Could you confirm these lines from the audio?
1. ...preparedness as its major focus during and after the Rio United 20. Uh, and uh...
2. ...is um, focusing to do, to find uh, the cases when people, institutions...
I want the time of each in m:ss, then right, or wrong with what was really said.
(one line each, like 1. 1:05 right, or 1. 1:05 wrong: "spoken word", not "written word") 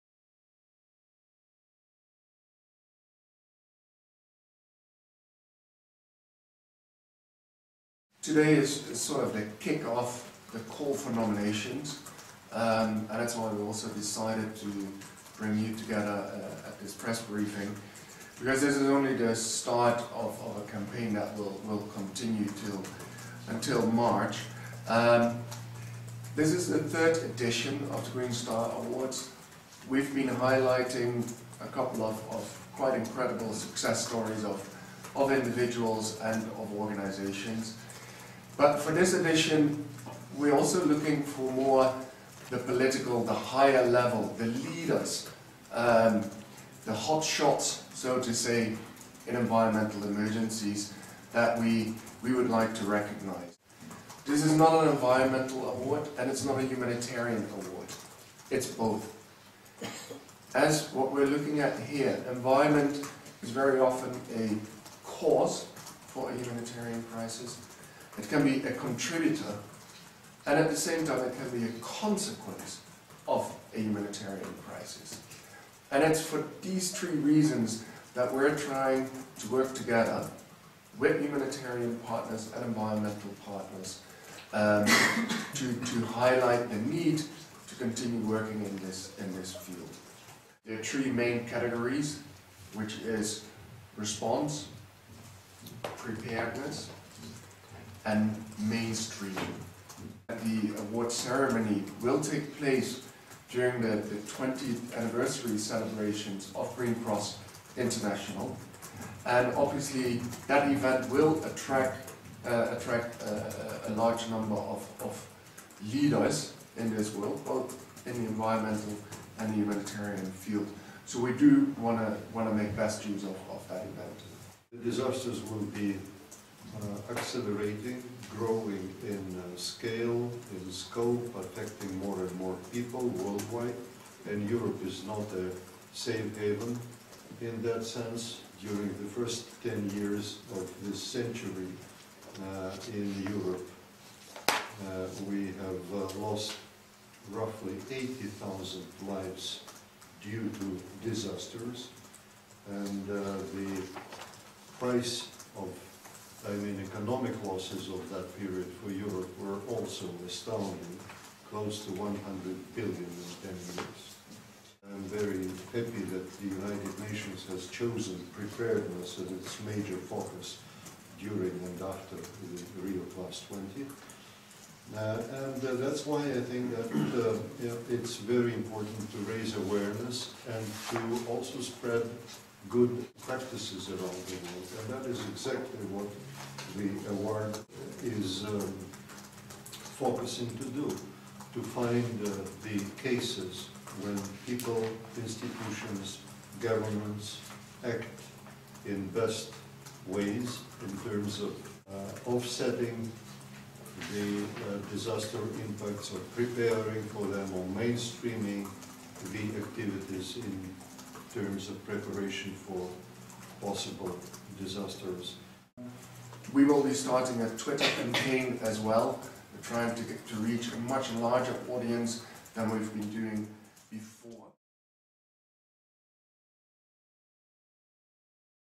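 1. 2:48 wrong: "Plus", not "United"
2. 3:08 right.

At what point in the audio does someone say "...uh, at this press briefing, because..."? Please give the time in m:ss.
0:16.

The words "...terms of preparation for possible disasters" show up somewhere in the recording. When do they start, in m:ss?
3:31.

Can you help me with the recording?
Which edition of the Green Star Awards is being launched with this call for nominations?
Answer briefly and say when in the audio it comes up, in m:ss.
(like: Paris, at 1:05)
third, at 0:26.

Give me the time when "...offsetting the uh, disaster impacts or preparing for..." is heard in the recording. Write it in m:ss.
3:22.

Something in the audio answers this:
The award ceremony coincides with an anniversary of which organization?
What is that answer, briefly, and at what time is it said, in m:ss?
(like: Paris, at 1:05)
Green Cross International, at 1:46.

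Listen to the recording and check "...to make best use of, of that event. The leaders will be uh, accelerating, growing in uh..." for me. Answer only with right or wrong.
wrong.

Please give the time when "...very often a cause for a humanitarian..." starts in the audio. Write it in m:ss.
1:03.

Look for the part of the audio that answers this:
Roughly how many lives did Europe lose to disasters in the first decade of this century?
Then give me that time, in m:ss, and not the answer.
2:27.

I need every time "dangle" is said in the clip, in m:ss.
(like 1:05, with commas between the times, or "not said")
not said.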